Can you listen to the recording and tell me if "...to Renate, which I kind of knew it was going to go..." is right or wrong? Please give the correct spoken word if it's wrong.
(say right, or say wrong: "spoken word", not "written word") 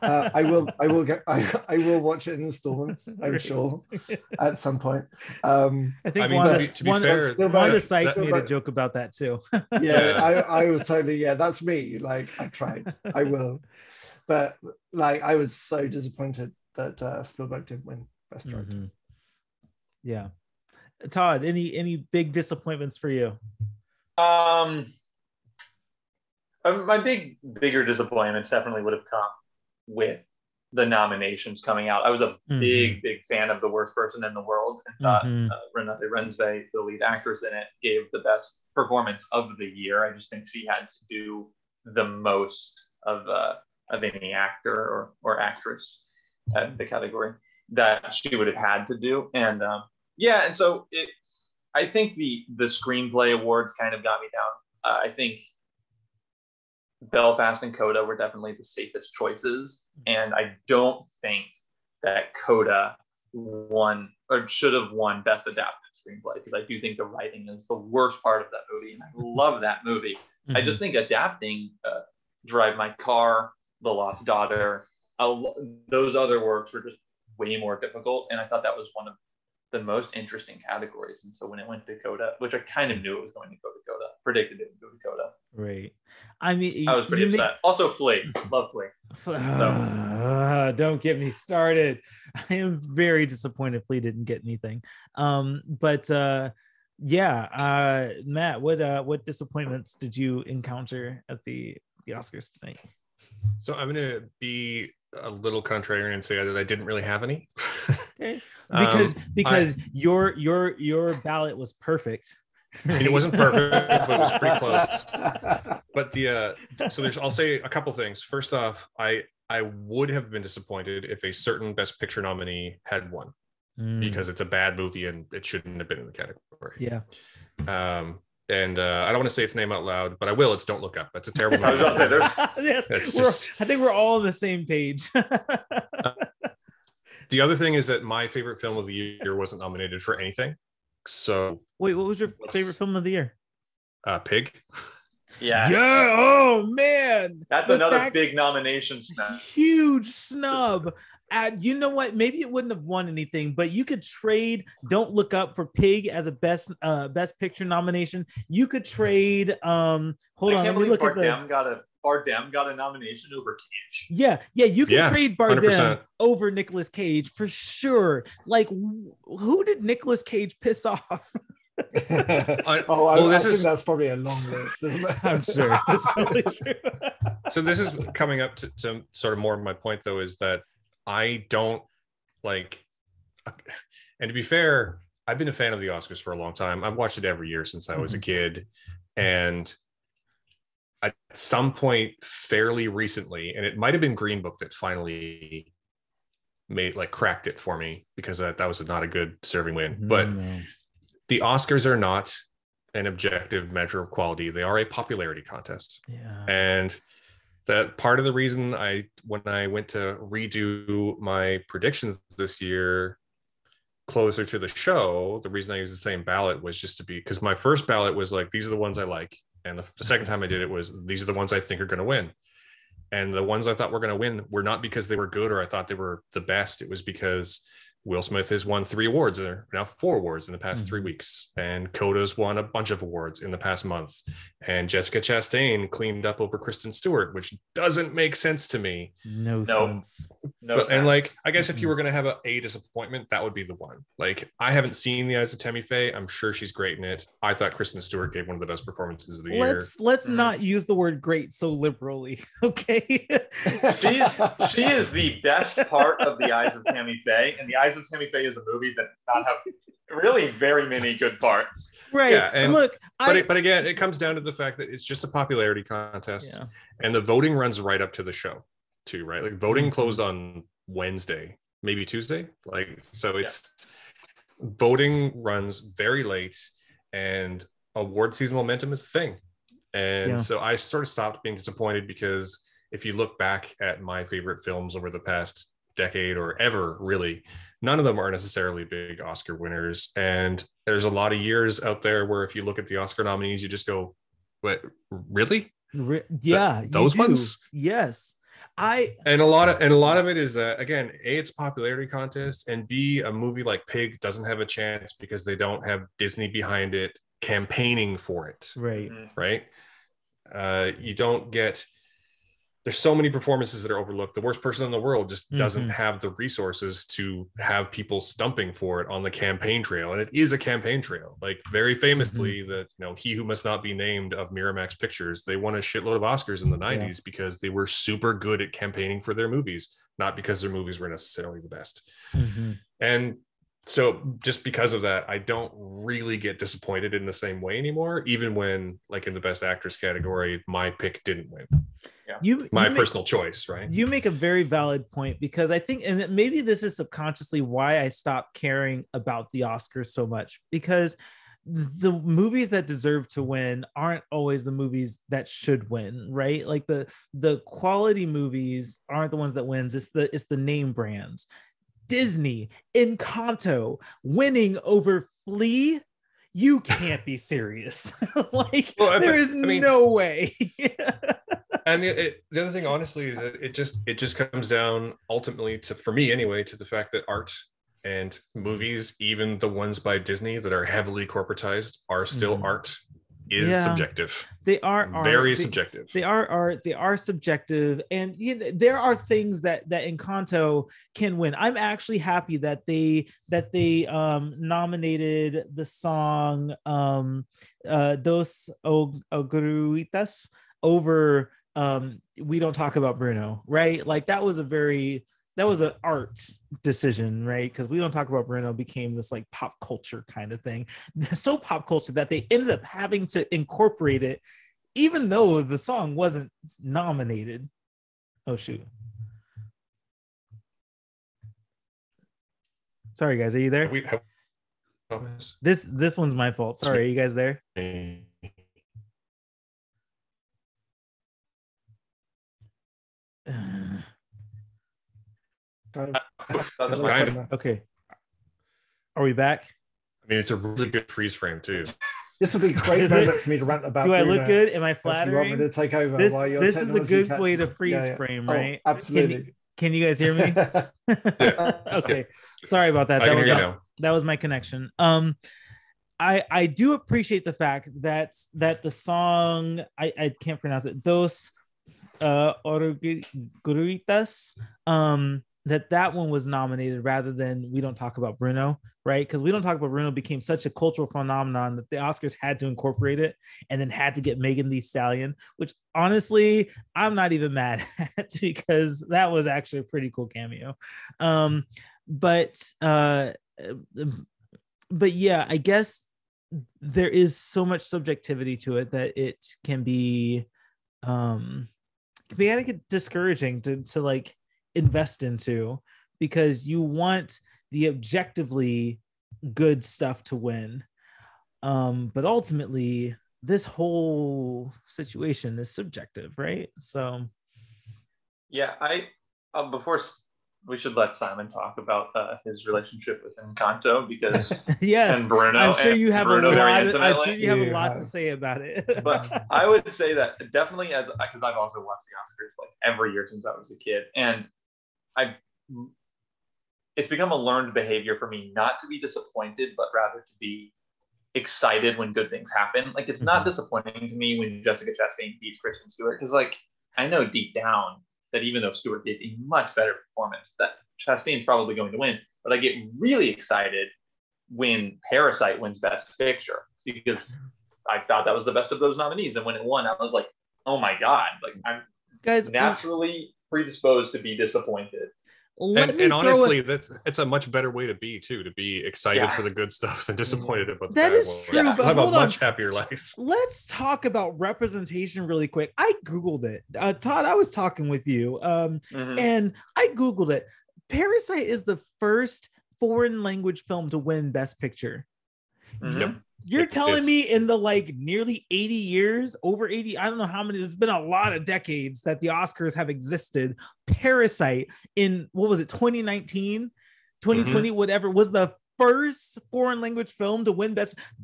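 wrong: "Coda", not "Renate".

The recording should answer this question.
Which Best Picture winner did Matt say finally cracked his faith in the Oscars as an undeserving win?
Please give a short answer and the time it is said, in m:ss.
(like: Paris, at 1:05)
Green Book, at 3:14.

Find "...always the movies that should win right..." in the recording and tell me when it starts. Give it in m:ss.
5:54.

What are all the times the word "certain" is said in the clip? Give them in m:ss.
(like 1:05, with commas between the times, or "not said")
2:01.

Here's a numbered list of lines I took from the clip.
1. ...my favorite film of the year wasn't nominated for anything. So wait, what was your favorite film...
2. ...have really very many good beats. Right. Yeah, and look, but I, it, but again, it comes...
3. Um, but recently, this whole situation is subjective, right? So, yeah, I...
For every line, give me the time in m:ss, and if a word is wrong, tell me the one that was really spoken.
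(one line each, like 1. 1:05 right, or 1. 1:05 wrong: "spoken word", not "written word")
1. 2:18 right
2. 4:19 wrong: "parts", not "beats"
3. 8:21 wrong: "ultimately", not "recently".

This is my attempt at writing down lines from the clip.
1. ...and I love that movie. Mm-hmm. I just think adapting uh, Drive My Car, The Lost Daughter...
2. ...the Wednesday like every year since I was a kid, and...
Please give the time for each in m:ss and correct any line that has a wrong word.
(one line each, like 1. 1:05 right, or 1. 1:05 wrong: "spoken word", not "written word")
1. 1:08 right
2. 8:42 wrong: "Oscars", not "Wednesday".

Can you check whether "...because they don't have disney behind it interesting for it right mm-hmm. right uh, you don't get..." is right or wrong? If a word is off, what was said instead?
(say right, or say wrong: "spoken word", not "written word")
wrong: "campaigning", not "interesting".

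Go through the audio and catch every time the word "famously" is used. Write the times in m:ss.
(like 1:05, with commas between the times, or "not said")
5:21.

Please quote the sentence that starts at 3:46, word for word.
It was because Will Smith has won three awards and now four awards in the past mm-hmm.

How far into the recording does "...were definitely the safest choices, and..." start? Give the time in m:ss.
0:58.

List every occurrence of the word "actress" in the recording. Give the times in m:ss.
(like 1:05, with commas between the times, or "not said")
0:37, 0:45, 5:39.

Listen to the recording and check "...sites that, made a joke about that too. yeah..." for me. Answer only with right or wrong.
right.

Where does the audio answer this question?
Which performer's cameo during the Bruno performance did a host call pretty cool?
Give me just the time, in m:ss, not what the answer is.
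7:54.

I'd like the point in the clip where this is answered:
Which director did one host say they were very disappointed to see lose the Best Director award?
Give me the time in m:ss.
0:17.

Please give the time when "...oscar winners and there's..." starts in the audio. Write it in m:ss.
4:49.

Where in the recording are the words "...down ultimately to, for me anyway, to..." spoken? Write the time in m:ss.
6:14.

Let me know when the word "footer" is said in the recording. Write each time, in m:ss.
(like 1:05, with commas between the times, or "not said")
not said.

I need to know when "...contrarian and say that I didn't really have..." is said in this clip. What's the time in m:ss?
1:45.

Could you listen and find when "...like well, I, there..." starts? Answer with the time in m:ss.
6:08.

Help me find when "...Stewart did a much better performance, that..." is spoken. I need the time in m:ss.
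8:58.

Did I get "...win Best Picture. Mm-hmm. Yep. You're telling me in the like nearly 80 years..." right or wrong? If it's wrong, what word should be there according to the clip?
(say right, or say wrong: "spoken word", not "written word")
right.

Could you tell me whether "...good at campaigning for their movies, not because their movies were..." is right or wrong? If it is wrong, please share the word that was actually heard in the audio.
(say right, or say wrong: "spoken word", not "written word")
right.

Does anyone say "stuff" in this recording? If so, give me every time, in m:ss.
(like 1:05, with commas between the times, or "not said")
8:19, 9:19.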